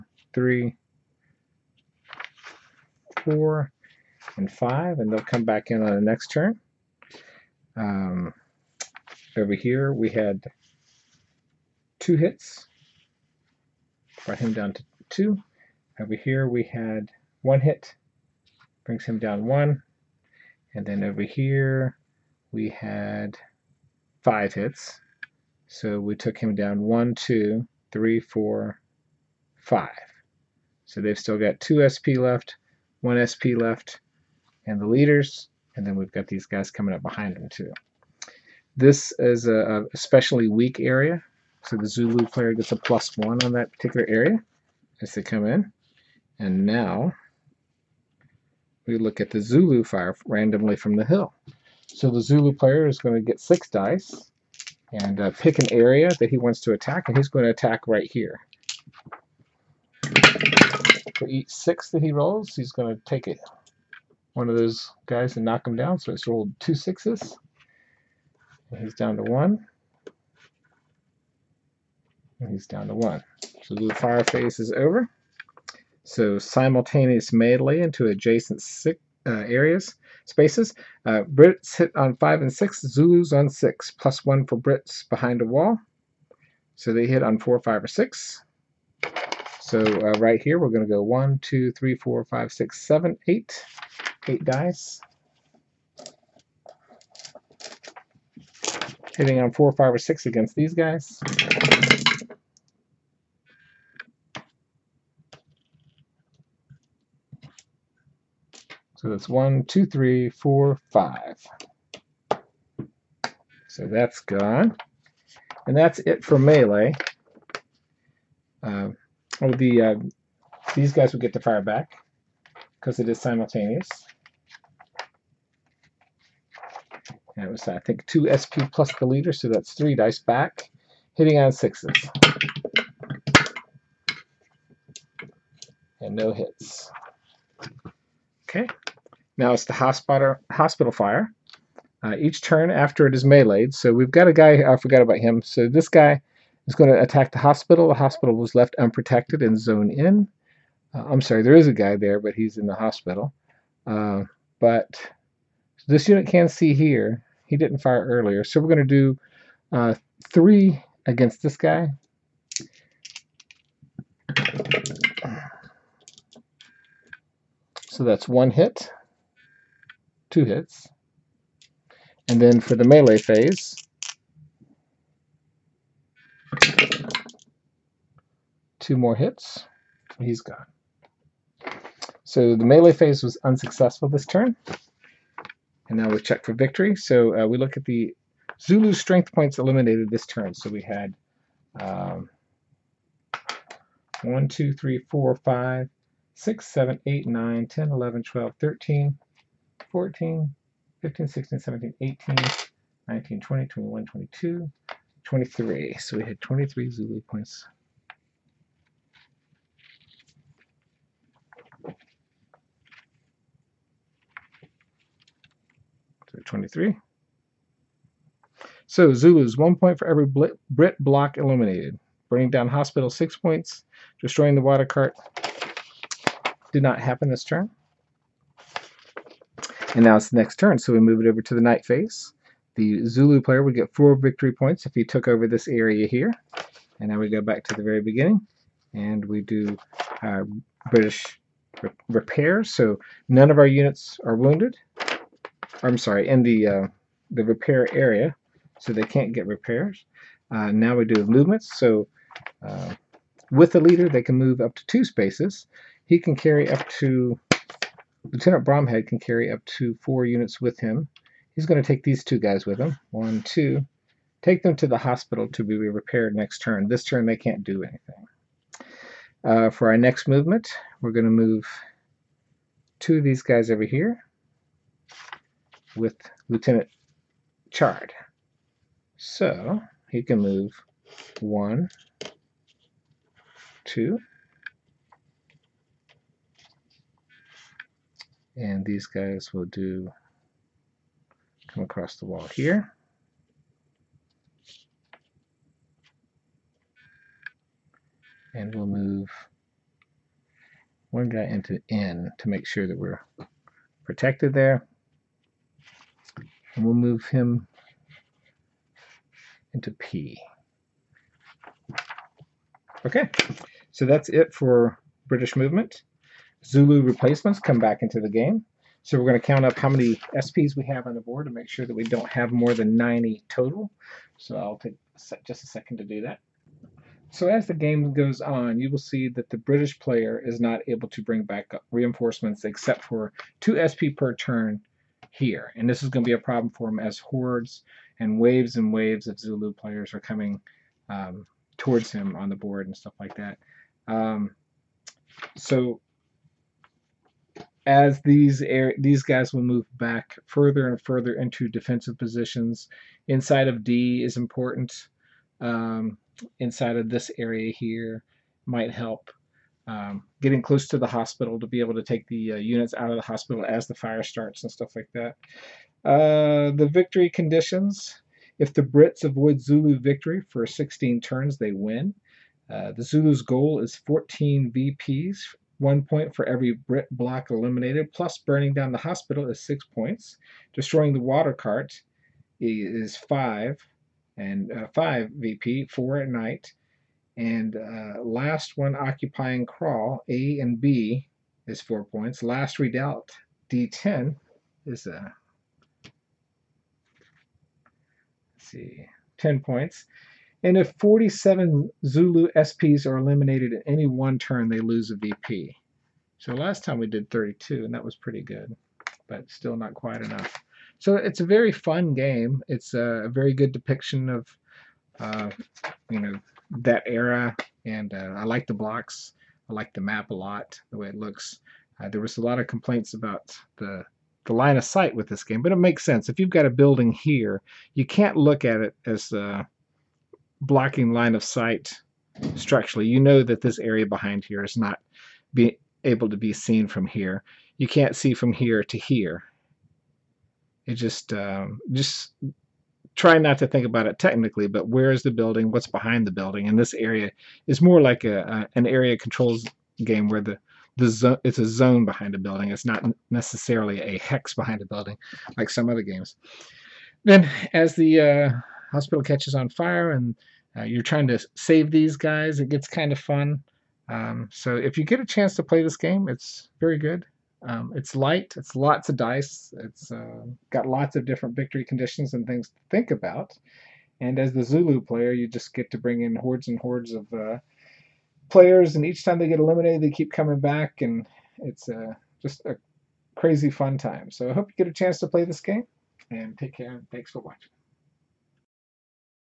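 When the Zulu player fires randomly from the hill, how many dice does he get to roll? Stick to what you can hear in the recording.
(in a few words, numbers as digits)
6.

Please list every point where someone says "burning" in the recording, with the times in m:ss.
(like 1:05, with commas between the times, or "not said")
3:42, 6:18.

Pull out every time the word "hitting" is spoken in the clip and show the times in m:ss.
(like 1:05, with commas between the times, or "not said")
1:39, 2:11.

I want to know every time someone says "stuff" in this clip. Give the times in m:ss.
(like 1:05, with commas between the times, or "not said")
5:42, 6:04.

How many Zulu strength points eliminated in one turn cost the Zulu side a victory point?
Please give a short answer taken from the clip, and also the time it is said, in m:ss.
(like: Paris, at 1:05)
47, at 6:40.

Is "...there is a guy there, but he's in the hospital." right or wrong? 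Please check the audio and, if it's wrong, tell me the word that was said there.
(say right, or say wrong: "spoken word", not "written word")
right.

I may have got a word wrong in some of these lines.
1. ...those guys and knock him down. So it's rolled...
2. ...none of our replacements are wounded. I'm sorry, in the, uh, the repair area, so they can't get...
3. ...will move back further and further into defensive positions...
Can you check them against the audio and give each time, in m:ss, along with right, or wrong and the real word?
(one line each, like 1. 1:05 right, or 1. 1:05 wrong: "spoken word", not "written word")
1. 1:04 right
2. 4:03 wrong: "units", not "replacements"
3. 5:49 right.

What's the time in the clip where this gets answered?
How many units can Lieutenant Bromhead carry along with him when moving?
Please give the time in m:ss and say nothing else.
4:20.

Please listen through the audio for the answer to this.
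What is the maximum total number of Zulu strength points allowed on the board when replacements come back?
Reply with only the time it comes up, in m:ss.
5:22.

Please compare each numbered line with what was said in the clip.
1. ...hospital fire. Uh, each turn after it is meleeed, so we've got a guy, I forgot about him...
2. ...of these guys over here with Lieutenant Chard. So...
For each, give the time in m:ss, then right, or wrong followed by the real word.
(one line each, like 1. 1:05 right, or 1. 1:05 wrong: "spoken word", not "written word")
1. 2:20 right
2. 4:33 right.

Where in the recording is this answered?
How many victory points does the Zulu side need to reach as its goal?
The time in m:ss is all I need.
6:14.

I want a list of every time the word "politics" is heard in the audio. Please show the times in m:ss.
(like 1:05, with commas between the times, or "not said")
not said.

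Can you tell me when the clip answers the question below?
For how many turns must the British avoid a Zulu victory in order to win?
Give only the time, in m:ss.
6:10.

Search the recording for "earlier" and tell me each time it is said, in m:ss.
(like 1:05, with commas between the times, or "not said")
2:38.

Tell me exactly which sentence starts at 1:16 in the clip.
So simultaneous melee into adjacent six, uh, areas, spaces.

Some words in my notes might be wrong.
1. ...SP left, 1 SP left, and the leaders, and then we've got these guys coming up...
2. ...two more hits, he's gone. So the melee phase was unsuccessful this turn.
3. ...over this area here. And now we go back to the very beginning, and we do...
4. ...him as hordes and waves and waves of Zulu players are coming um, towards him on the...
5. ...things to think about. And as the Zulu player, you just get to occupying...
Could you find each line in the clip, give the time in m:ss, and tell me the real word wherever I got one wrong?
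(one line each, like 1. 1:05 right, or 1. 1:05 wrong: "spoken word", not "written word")
1. 0:31 right
2. 2:58 right
3. 3:55 right
4. 5:36 right
5. 7:52 wrong: "bring", not "occupying".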